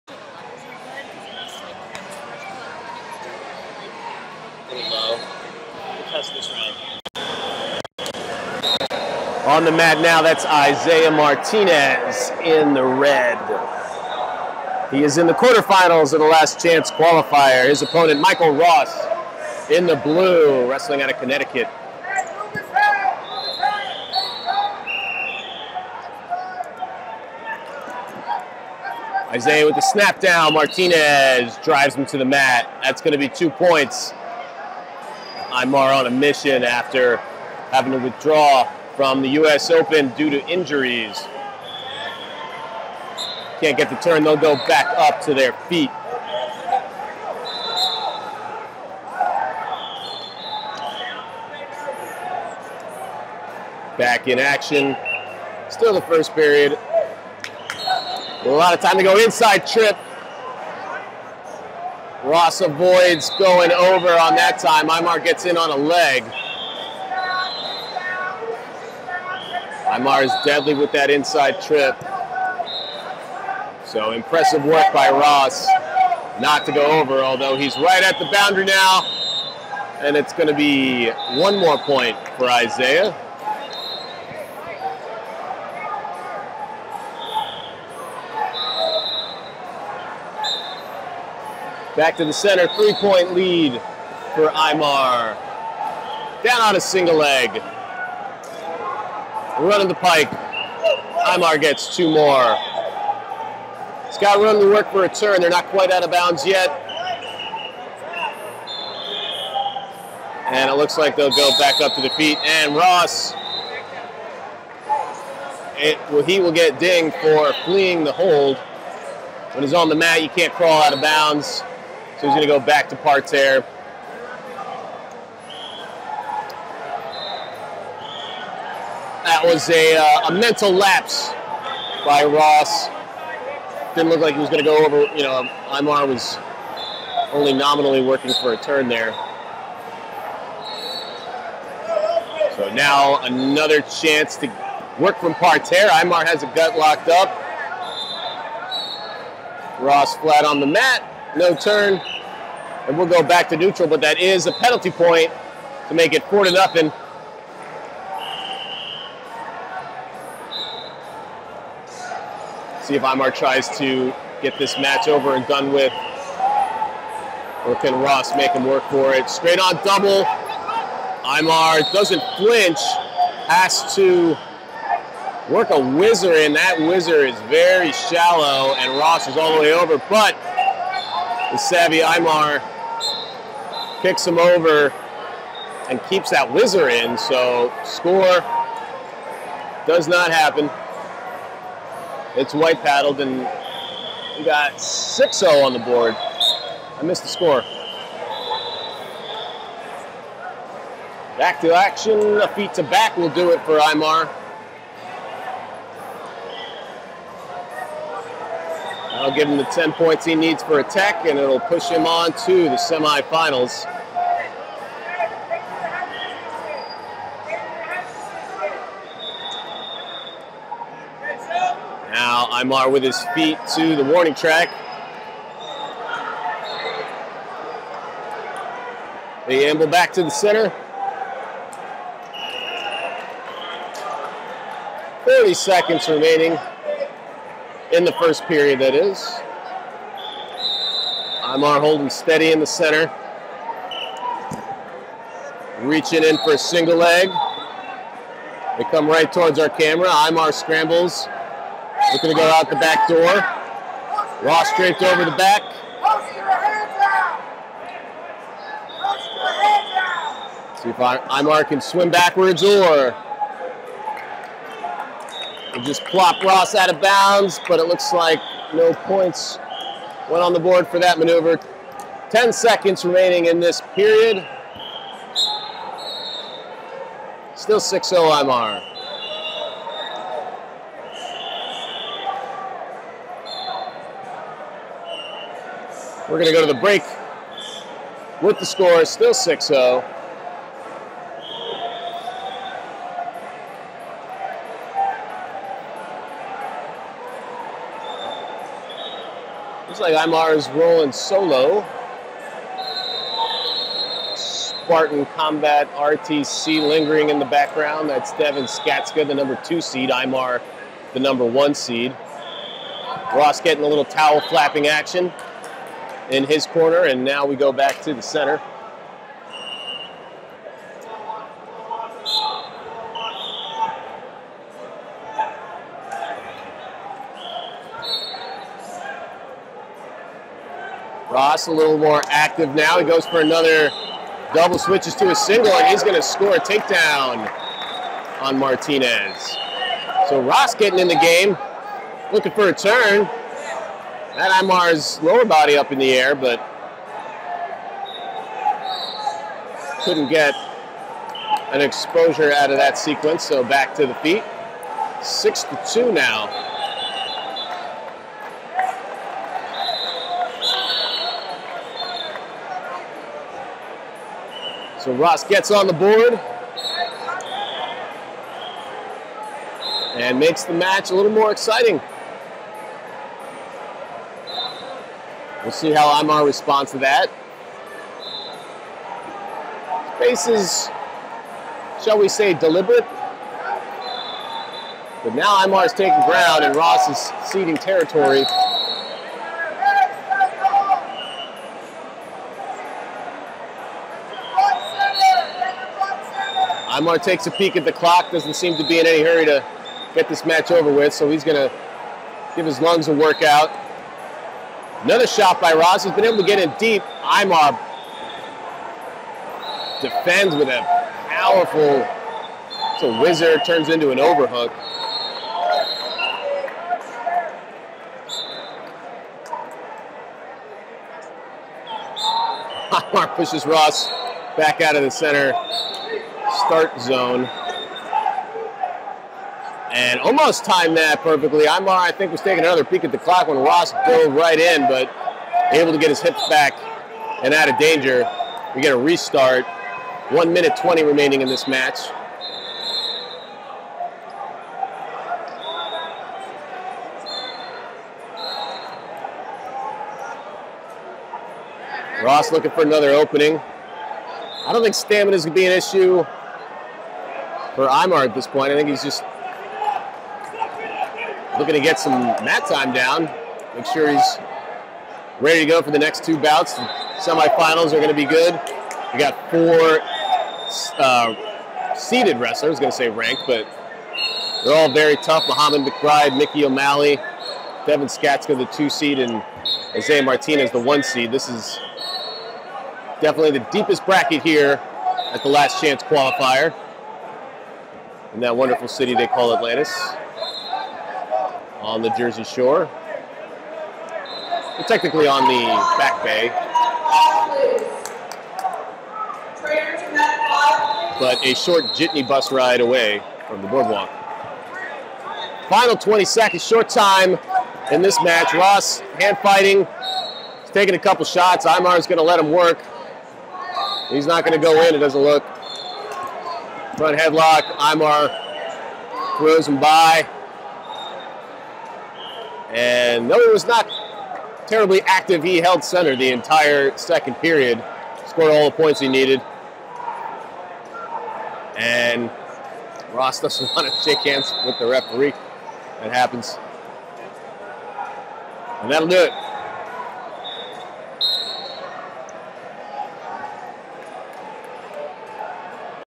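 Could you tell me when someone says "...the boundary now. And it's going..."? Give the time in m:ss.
1:18.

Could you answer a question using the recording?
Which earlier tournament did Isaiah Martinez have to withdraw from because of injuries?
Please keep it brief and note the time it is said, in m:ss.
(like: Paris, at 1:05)
U.S. Open, at 0:39.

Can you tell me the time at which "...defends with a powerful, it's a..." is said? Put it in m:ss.
6:50.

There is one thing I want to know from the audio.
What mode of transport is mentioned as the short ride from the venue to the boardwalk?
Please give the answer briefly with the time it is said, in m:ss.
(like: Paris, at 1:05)
Jitney bus, at 8:21.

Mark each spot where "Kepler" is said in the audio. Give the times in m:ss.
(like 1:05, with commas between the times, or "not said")
not said.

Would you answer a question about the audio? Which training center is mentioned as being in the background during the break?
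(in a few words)
Spartan Combat RTC.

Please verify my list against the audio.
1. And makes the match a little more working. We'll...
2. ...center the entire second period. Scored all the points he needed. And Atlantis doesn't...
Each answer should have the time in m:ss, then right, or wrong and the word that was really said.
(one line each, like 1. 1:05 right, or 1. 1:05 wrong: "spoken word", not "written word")
1. 6:10 wrong: "exciting", not "working"
2. 8:45 wrong: "Ross", not "Atlantis".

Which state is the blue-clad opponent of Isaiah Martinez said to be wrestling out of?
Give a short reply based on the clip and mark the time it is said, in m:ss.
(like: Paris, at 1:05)
Connecticut, at 0:21.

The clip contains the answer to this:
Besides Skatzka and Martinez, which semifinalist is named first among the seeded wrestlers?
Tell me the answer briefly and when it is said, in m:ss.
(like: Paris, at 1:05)
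Muhammad McBride, at 7:55.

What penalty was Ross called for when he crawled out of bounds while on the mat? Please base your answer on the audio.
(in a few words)
Fleeing the hold.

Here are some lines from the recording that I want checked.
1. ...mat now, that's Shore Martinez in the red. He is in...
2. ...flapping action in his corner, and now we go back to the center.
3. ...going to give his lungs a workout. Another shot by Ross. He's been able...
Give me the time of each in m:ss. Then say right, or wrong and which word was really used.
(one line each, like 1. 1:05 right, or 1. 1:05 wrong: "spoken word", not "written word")
1. 0:09 wrong: "Isaiah", not "Shore"
2. 5:14 right
3. 6:41 right.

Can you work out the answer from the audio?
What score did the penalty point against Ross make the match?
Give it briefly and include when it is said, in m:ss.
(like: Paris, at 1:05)
4-0, at 2:36.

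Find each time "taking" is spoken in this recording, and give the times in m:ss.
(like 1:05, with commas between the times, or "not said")
6:25, 7:12, 8:30.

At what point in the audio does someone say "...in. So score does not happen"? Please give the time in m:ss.
3:06.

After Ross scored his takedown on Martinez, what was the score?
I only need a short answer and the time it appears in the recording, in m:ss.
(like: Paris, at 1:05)
6-2, at 5:55.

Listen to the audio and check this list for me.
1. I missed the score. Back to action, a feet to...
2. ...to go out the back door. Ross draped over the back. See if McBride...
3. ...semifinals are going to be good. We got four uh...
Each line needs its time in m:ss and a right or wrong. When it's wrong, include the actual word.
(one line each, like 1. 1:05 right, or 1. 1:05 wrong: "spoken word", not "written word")
1. 3:16 right
2. 4:12 wrong: "Imar", not "McBride"
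3. 7:47 right.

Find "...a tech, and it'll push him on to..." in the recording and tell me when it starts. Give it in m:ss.
3:30.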